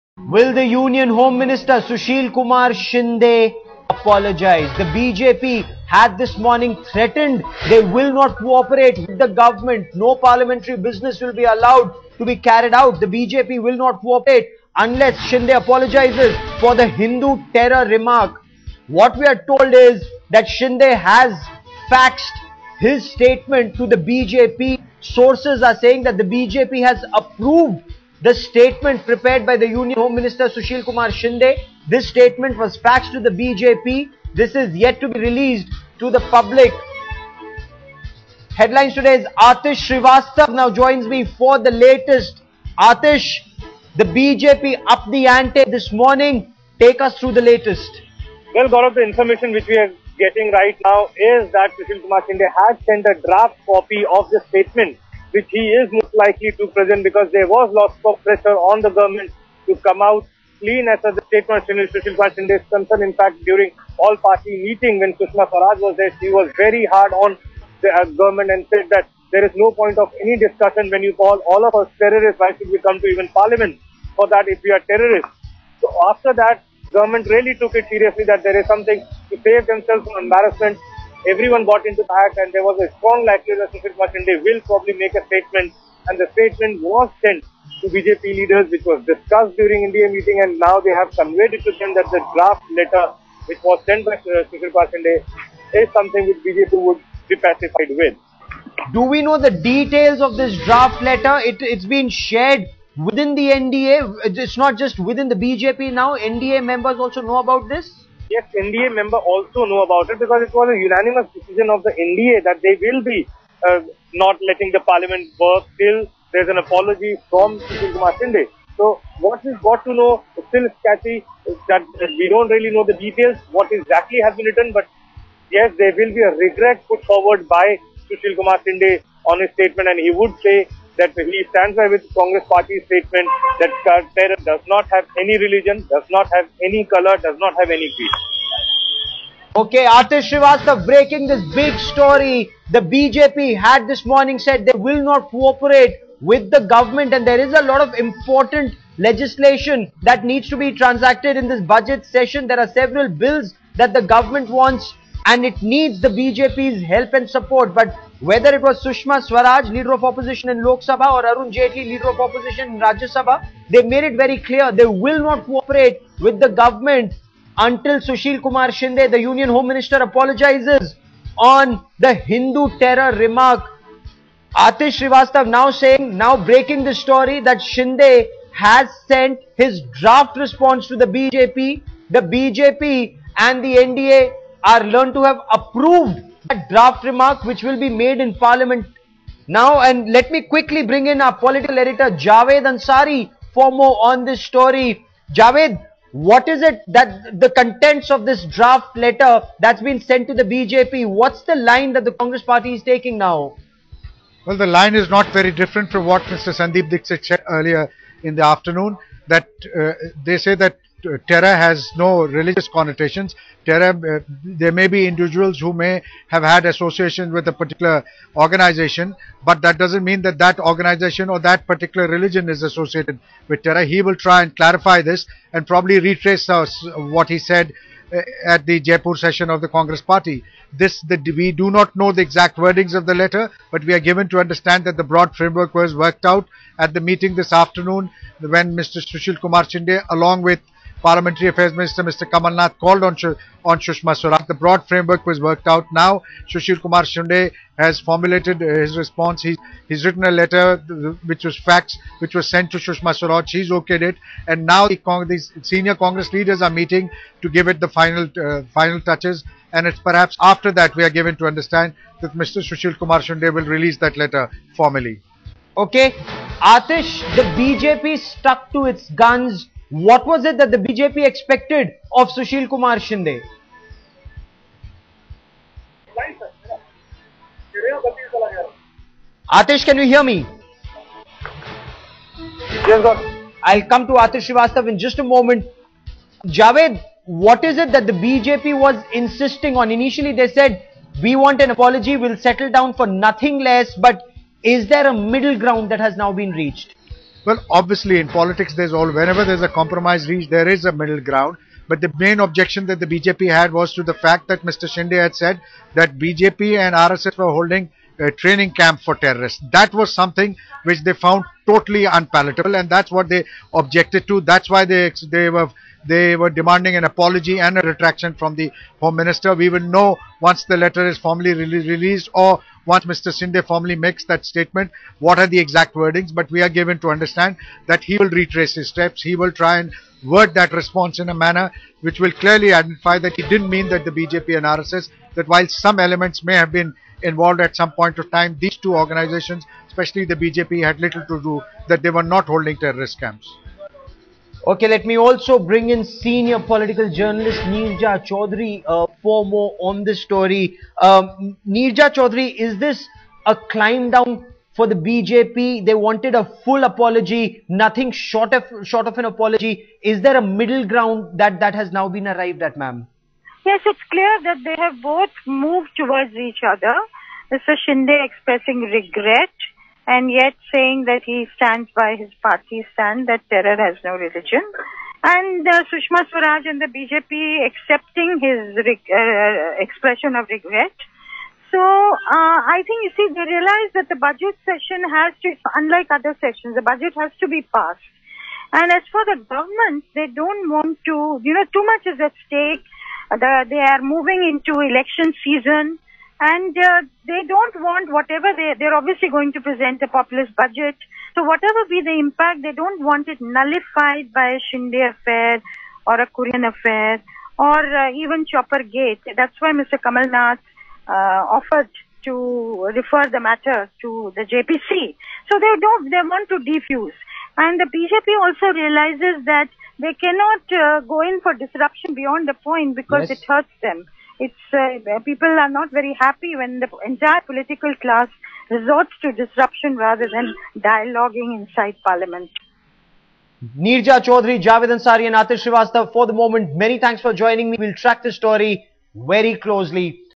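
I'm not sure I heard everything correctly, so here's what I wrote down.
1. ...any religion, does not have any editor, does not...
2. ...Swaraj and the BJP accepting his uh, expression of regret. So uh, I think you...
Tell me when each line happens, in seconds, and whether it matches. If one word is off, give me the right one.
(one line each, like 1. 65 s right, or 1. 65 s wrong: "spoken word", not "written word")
1. 135 s wrong: "color", not "editor"
2. 376 s right.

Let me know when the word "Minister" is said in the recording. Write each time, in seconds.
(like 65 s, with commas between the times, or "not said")
1 s, 30 s, 169 s, 241 s, 319 s.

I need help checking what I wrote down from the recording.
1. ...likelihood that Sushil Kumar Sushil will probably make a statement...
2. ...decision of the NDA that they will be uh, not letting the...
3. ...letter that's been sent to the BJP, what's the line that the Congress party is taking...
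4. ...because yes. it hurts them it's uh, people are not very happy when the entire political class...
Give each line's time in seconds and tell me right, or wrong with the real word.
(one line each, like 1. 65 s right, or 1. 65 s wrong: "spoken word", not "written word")
1. 83 s wrong: "Shinde", not "Sushil"
2. 111 s right
3. 198 s right
4. 422 s right.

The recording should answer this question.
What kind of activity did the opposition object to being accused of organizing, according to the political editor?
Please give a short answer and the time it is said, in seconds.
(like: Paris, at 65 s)
Training camp for terrorists, at 308 s.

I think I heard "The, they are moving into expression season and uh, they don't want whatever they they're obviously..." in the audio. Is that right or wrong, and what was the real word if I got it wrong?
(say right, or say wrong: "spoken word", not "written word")
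wrong: "election", not "expression".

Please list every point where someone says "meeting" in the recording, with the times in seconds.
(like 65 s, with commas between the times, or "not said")
64 s, 90 s, 237 s, 256 s.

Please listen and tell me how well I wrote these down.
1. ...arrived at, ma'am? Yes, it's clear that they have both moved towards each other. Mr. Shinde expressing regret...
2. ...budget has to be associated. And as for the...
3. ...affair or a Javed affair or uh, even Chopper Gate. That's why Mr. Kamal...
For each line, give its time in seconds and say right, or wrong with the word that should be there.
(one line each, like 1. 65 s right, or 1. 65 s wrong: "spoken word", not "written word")
1. 362 s right
2. 386 s wrong: "passed", not "associated"
3. 405 s wrong: "Kurien", not "Javed".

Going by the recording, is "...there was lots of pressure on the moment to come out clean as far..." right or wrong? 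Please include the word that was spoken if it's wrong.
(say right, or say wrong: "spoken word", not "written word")
wrong: "government", not "moment".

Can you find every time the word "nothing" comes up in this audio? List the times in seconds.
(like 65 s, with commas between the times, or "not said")
293 s, 357 s.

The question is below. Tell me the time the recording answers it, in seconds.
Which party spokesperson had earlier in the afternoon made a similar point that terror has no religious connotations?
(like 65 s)
206 s.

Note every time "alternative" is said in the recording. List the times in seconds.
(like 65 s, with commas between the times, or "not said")
not said.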